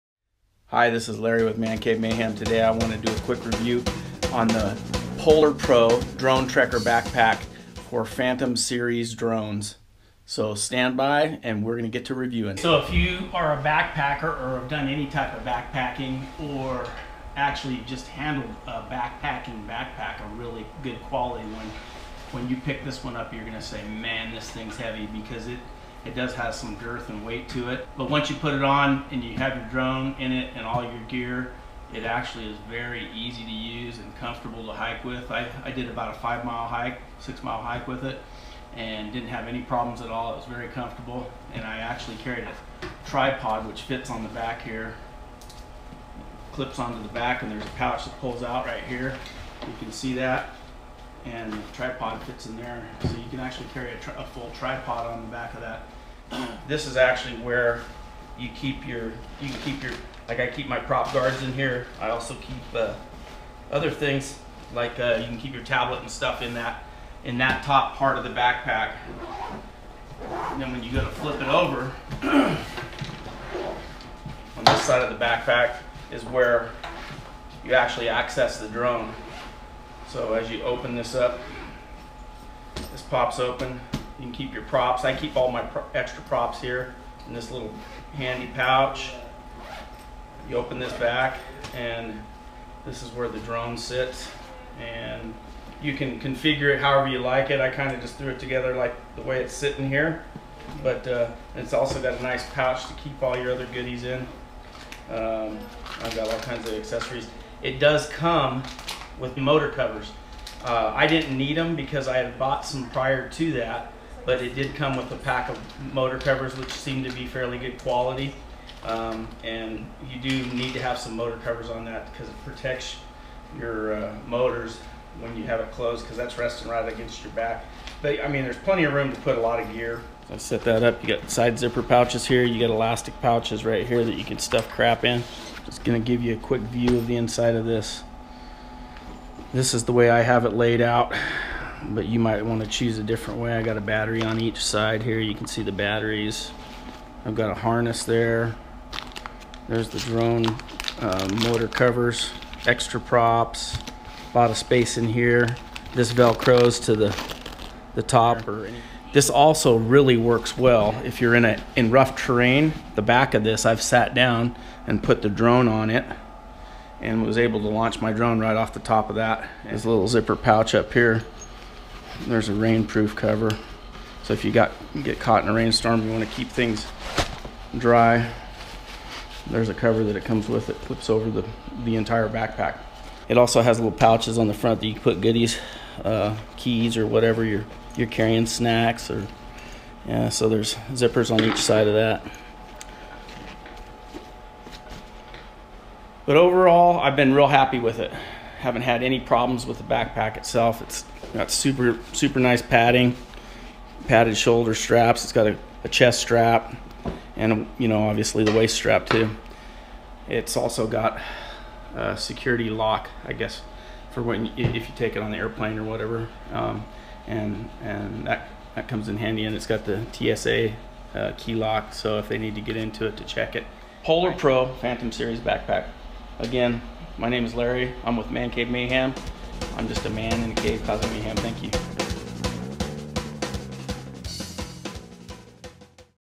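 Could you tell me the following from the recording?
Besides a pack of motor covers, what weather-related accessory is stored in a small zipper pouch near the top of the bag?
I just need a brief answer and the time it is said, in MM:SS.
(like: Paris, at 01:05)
rainproof cover, at 02:52.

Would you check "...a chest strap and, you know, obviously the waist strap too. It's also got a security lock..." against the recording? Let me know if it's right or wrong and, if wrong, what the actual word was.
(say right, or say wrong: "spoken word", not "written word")
right.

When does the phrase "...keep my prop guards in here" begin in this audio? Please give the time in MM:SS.
01:00.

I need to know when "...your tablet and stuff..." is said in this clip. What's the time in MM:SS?
01:05.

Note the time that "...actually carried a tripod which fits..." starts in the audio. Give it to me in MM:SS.
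00:41.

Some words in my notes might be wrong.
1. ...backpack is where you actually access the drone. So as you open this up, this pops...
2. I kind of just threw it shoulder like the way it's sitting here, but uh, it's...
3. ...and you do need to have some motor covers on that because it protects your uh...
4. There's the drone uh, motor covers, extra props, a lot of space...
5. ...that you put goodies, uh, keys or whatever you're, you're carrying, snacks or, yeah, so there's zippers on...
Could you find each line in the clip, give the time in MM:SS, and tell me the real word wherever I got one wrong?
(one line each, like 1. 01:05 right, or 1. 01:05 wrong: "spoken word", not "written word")
1. 01:15 right
2. 01:37 wrong: "together", not "shoulder"
3. 01:59 right
4. 02:29 right
5. 03:04 right.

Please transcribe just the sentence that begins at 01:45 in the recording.
Um, I've got all kinds of accessories.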